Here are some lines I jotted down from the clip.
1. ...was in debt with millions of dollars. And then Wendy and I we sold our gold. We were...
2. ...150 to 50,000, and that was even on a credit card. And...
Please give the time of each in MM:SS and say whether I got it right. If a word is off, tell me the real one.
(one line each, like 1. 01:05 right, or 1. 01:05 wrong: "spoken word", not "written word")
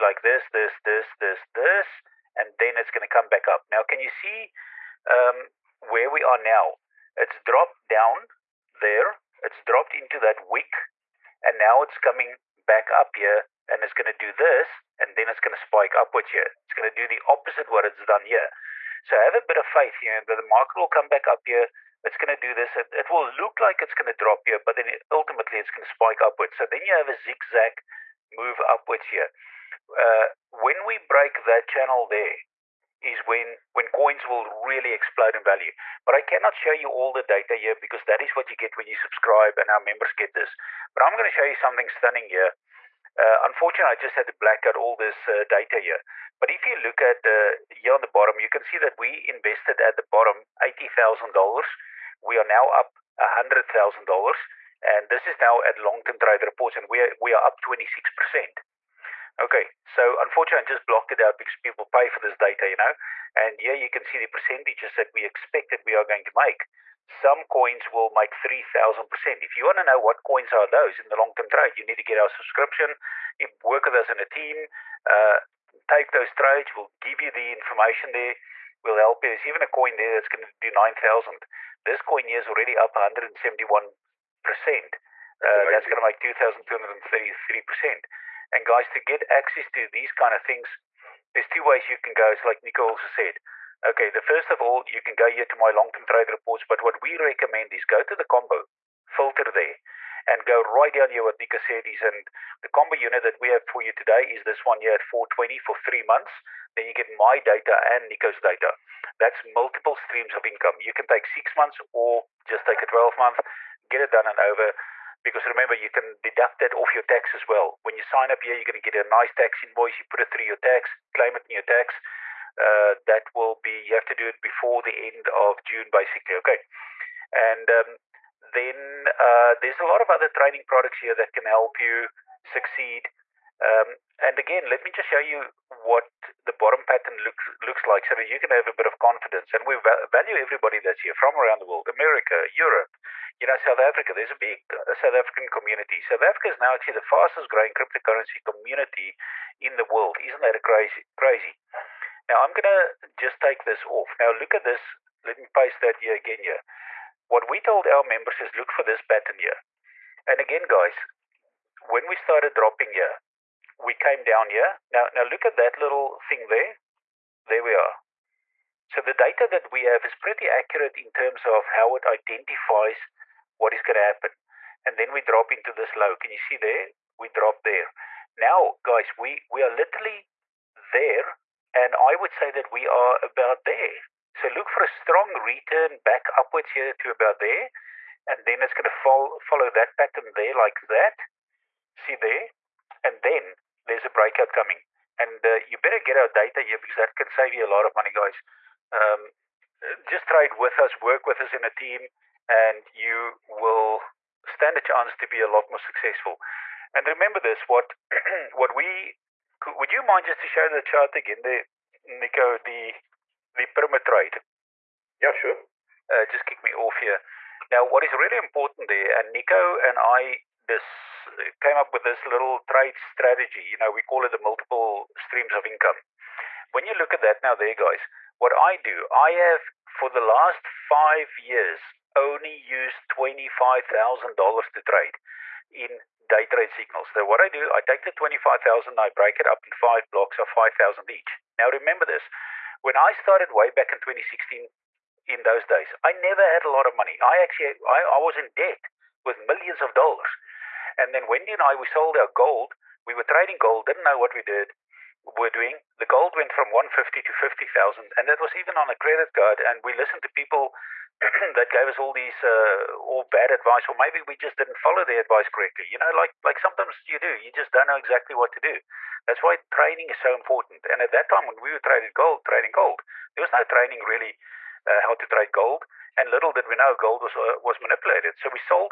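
1. 04:08 right
2. 04:16 right.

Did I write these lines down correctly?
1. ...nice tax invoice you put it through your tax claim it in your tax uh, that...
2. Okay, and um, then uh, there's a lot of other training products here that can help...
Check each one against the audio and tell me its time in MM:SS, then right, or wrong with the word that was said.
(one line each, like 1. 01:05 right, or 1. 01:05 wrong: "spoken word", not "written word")
1. 01:59 right
2. 02:06 right.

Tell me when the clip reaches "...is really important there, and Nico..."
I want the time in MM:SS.
03:38.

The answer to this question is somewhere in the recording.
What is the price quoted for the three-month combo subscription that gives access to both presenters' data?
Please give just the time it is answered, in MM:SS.
01:45.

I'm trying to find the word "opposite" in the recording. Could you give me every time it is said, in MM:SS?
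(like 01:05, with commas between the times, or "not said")
00:17.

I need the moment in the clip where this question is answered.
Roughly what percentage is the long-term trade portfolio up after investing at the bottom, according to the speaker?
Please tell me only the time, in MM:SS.
00:57.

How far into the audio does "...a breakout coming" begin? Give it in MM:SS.
03:14.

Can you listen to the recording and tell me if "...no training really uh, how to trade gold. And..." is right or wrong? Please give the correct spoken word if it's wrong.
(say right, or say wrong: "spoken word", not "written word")
right.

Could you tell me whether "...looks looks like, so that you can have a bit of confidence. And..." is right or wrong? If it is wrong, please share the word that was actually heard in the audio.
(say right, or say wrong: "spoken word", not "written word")
right.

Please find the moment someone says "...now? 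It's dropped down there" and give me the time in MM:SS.
00:06.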